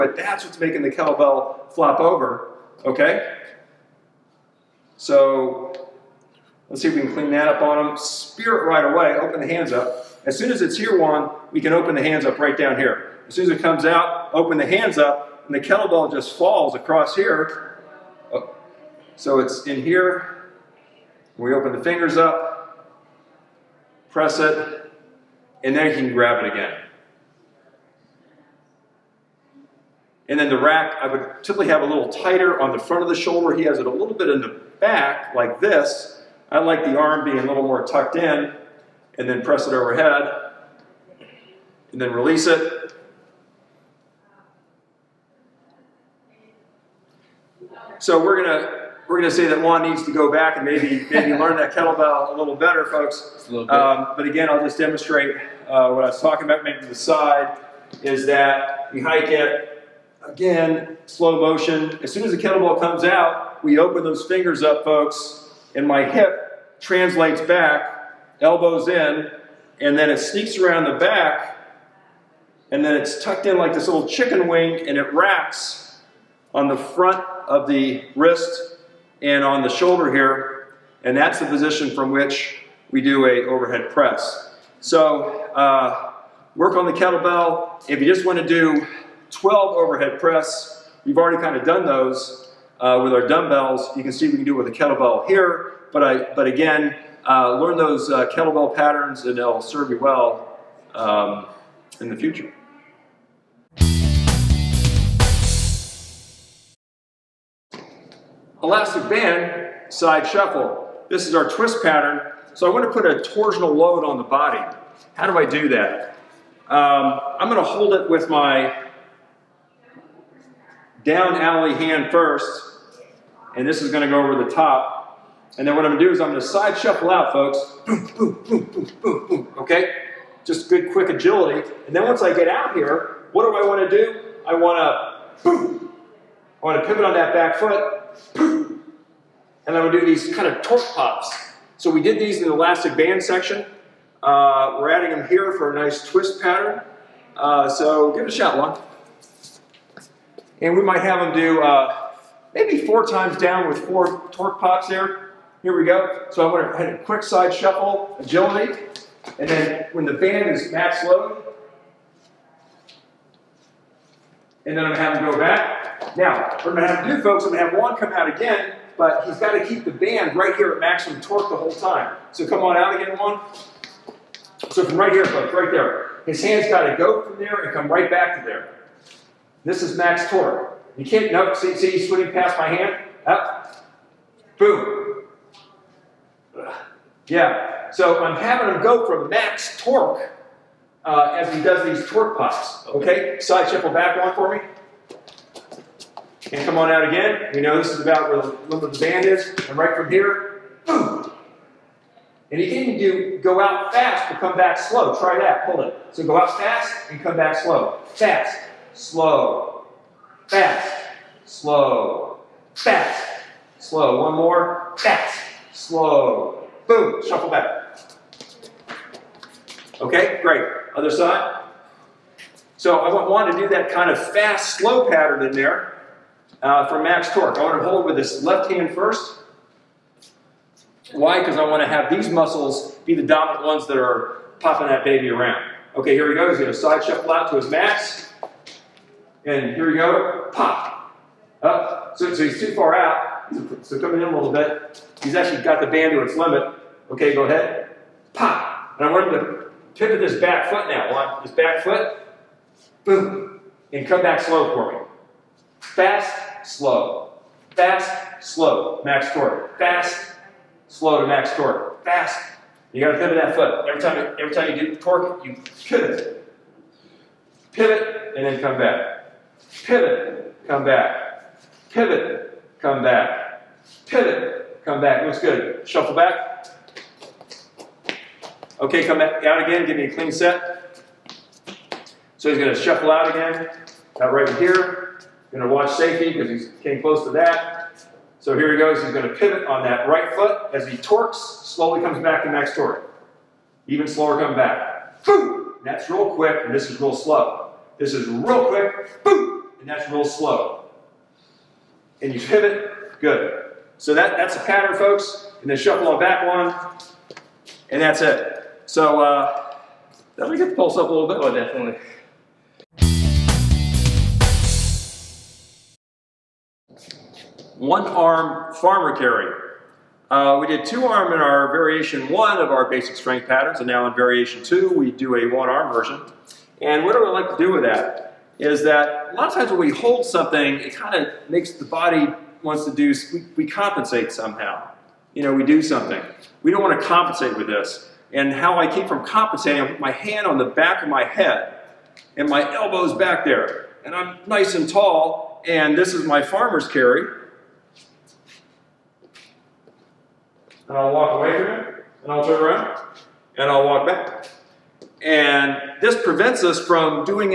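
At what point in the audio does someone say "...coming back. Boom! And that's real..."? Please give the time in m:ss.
4:54.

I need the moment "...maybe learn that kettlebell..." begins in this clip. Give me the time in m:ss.
0:51.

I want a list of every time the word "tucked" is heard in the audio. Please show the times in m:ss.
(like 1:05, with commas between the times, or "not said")
0:37, 1:13.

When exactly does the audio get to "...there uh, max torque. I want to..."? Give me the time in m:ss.
3:45.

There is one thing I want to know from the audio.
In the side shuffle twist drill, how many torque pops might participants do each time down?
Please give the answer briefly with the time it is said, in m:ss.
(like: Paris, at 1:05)
4, at 2:33.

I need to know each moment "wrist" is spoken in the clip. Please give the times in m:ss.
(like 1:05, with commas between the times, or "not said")
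1:18.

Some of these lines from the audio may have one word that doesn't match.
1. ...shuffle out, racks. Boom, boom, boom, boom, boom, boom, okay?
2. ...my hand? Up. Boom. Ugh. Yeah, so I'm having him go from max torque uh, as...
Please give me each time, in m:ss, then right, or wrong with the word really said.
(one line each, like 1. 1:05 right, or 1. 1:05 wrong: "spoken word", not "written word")
1. 2:06 wrong: "folks", not "racks"
2. 3:02 right.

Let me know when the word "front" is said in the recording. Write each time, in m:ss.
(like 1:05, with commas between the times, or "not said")
0:32, 1:16.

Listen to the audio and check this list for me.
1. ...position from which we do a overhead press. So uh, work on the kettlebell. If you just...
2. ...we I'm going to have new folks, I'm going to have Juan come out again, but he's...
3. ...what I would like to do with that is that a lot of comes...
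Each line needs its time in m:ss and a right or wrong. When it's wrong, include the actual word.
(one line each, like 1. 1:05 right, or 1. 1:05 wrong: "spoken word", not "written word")
1. 1:21 right
2. 2:46 right
3. 5:27 wrong: "times", not "comes".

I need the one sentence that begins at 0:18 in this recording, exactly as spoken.
Oh, so it's in here, we open the fingers up, press it, and then you can grab it again.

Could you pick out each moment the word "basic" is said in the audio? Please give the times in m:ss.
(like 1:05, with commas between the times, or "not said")
5:22.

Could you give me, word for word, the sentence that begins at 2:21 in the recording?
So we did these in the elastic band section.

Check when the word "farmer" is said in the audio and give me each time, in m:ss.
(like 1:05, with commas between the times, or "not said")
5:18, 5:46.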